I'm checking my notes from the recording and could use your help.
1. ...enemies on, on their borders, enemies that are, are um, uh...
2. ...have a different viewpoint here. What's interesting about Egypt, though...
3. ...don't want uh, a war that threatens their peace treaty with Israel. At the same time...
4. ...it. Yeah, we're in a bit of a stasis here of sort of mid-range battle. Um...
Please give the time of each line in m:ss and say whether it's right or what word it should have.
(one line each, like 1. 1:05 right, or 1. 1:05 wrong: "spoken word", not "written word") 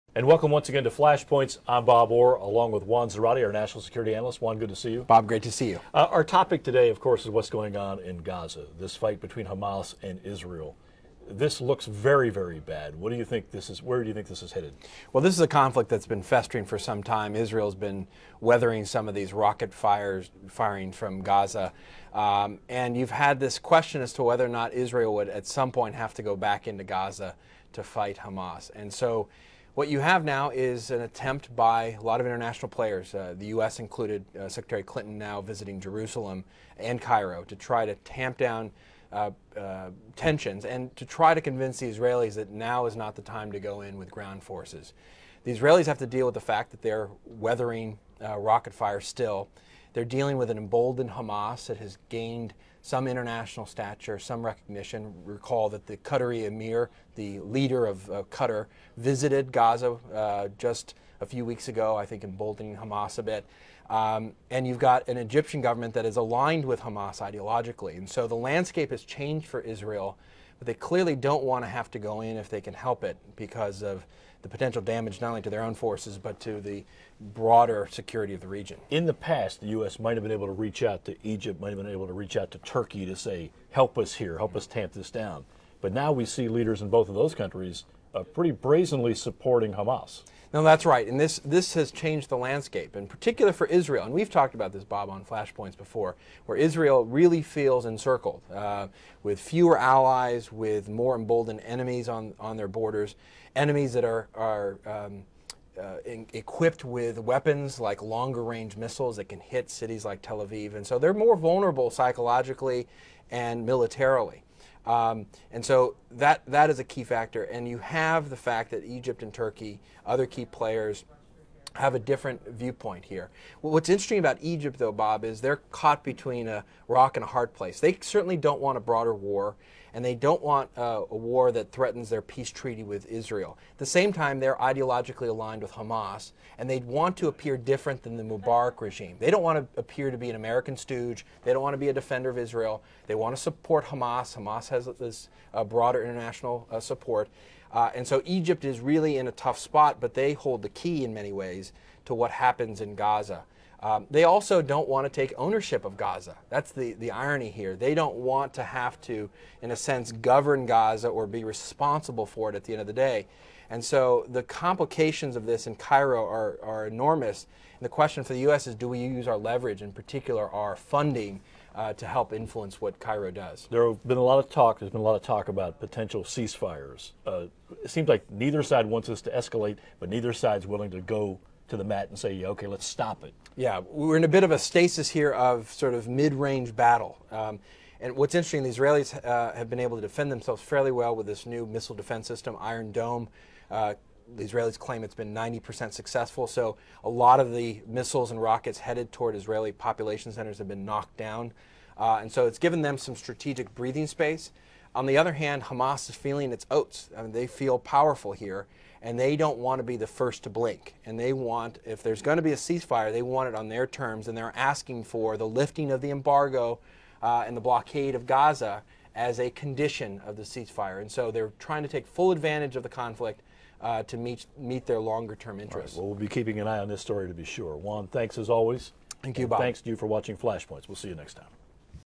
1. 1:41 right
2. 2:01 right
3. 2:10 right
4. 3:03 right.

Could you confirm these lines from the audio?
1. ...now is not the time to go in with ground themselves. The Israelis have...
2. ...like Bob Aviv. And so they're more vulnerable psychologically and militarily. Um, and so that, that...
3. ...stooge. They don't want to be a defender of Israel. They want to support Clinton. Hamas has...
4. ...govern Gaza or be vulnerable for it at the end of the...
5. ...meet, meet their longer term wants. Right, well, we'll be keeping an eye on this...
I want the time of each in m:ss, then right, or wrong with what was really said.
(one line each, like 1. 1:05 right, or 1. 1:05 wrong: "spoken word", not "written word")
1. 0:42 wrong: "forces", not "themselves"
2. 1:50 wrong: "Tel", not "Bob"
3. 2:20 wrong: "Hamas", not "Clinton"
4. 2:40 wrong: "responsible", not "vulnerable"
5. 3:44 wrong: "interests", not "wants".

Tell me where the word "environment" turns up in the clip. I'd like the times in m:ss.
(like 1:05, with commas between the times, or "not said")
not said.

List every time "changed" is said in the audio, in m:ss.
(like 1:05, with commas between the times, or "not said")
1:09, 1:31.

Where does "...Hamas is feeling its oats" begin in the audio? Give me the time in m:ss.
3:25.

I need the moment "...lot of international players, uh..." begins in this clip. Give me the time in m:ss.
0:32.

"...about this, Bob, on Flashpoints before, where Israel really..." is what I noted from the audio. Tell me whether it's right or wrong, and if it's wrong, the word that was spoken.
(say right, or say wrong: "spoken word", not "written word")
right.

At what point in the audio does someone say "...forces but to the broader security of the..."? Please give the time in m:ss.
1:15.